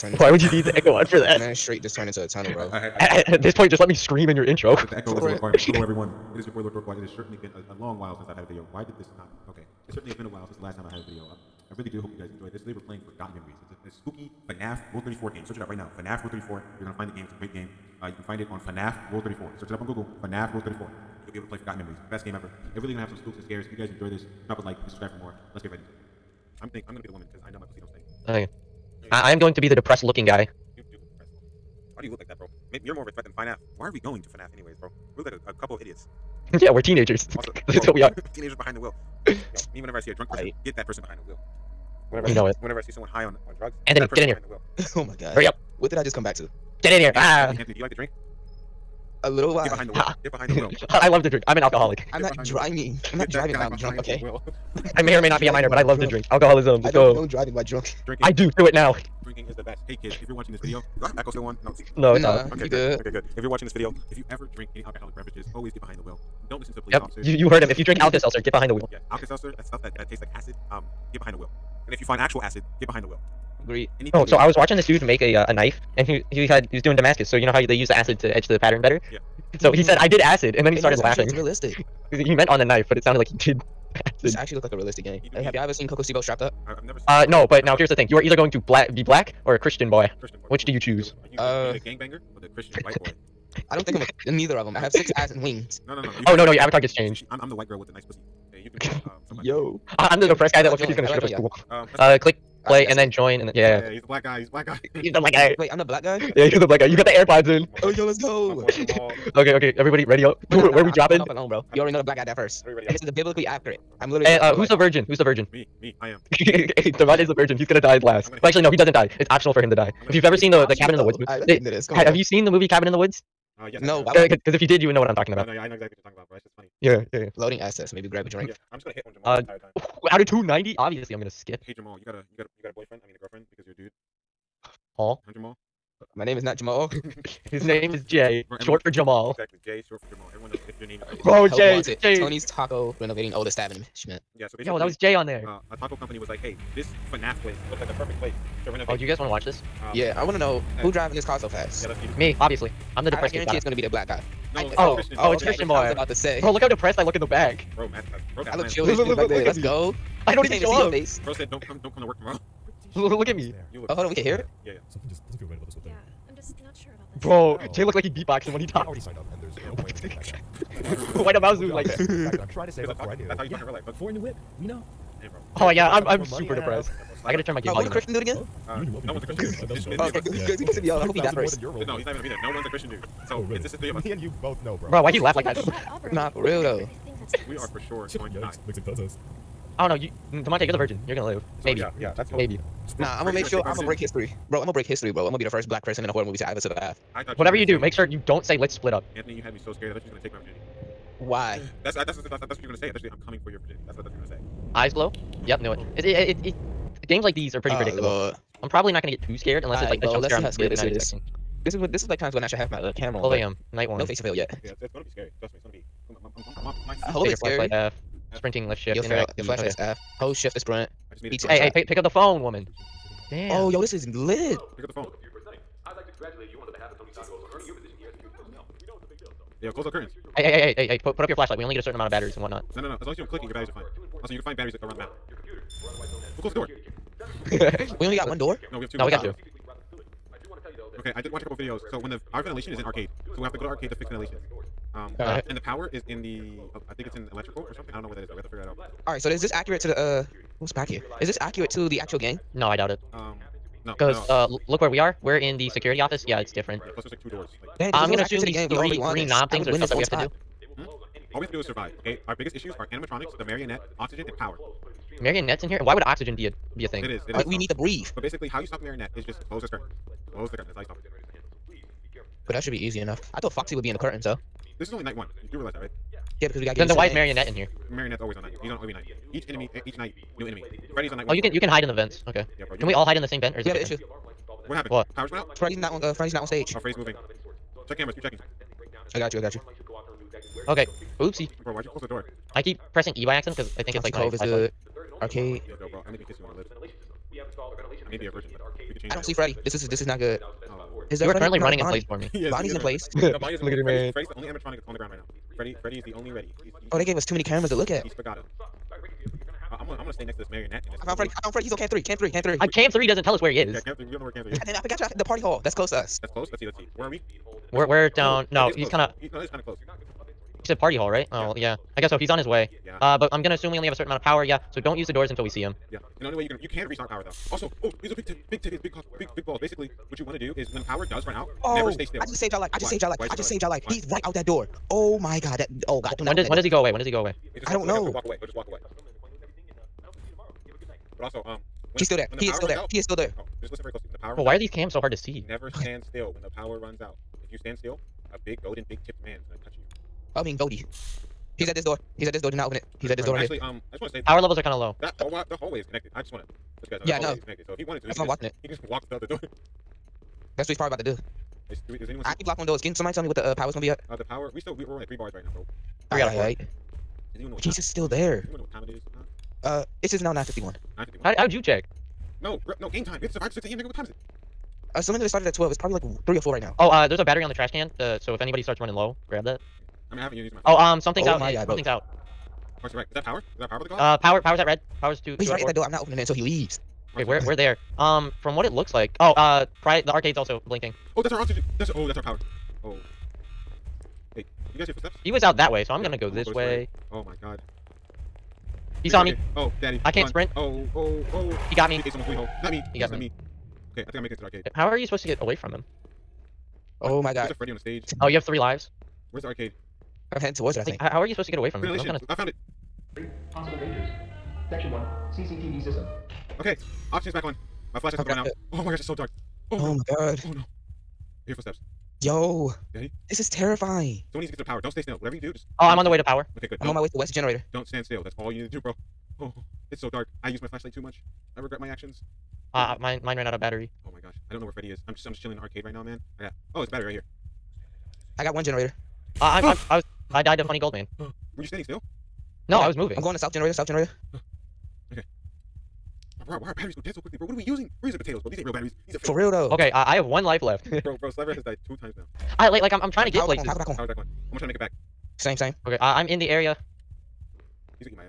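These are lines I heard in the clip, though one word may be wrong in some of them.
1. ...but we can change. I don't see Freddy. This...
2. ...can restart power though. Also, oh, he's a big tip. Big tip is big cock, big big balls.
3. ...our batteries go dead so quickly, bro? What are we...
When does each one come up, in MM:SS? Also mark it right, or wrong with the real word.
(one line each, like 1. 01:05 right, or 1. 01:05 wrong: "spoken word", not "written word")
1. 04:58 right
2. 05:26 right
3. 07:26 right.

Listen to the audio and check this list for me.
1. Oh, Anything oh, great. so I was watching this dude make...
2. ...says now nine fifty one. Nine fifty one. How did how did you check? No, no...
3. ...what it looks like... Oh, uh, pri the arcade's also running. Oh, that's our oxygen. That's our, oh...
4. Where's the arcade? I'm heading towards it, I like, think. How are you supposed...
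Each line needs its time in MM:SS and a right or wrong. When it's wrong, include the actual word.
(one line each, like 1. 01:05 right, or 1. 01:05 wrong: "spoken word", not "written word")
1. 01:13 right
2. 06:10 right
3. 06:28 wrong: "blinking", not "running"
4. 06:49 right.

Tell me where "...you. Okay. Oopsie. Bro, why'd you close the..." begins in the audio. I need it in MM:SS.
04:49.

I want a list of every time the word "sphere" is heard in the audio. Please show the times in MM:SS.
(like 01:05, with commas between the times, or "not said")
not said.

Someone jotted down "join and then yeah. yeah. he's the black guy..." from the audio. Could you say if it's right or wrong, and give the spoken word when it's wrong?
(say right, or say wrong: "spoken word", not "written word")
right.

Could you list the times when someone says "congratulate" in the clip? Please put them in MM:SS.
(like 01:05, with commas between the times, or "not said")
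03:46.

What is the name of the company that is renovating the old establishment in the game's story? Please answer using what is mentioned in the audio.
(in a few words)
Tony's Taco.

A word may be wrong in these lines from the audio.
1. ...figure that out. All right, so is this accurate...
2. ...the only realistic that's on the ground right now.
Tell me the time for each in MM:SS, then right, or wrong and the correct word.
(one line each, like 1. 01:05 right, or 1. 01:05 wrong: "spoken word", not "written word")
1. 04:08 right
2. 05:04 wrong: "animatronic", not "realistic".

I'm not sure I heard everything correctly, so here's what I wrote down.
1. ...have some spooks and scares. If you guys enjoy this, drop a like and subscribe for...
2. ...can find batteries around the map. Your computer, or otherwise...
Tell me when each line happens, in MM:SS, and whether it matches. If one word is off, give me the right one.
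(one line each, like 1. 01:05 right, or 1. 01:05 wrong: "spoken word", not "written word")
1. 00:23 right
2. 03:54 right.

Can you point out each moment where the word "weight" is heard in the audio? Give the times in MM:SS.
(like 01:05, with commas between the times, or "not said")
not said.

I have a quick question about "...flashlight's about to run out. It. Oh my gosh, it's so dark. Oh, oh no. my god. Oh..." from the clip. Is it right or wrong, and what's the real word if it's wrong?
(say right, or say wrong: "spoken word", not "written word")
right.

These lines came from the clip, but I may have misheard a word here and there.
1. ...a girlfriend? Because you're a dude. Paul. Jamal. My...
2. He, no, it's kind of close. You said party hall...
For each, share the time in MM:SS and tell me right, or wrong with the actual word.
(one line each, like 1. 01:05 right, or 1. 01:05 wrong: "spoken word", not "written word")
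1. 02:13 right
2. 05:19 right.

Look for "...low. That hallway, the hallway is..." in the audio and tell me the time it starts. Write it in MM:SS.
05:54.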